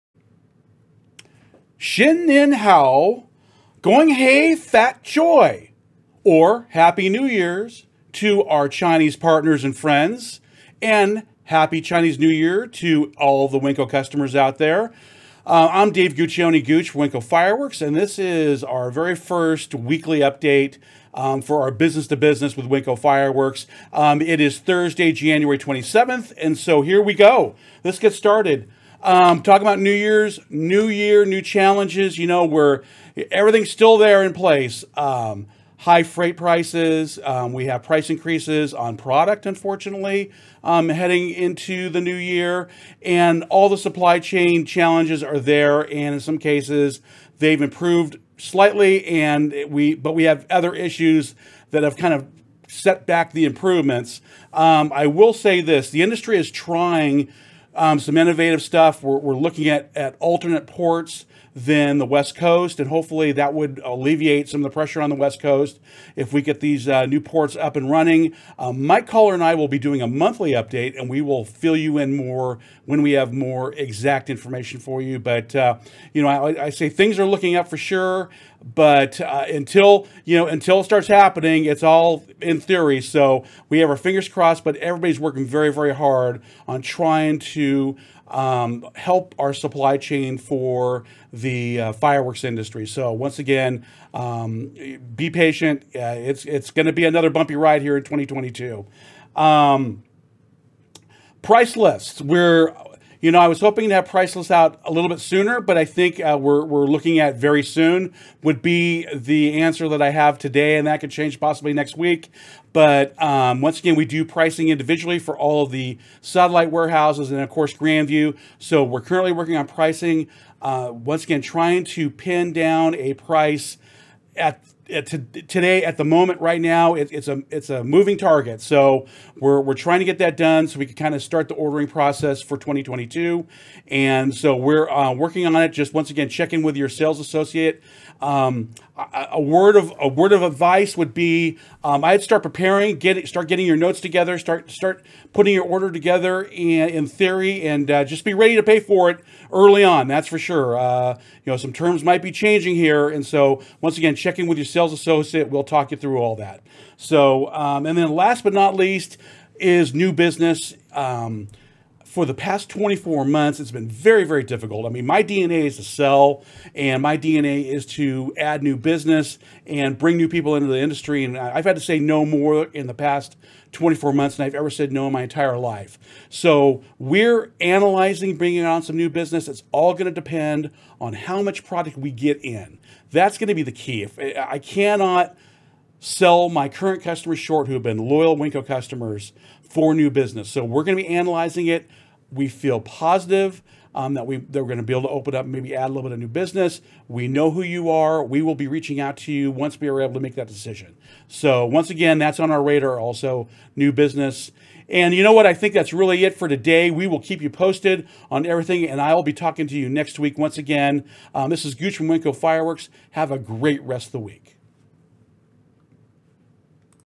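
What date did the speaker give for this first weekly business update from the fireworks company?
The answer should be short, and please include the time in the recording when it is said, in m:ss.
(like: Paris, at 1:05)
Thursday, January 27th, at 0:24.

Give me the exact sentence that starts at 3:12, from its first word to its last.
We feel positive um, that we they're going to be able to open up, maybe add a little bit of new business.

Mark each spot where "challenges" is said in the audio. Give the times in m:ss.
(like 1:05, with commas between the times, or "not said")
0:31, 0:44.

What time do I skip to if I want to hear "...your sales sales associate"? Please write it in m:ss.
2:34.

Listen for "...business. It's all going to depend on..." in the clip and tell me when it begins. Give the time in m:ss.
2:59.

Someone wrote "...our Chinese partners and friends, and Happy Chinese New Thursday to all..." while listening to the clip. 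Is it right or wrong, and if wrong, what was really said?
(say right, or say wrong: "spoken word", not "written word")
wrong: "Year", not "Thursday".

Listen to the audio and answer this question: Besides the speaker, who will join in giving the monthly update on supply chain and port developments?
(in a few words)
Mike Caller.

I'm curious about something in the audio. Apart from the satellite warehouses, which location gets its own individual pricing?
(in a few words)
Grandview.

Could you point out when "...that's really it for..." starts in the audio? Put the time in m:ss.
3:25.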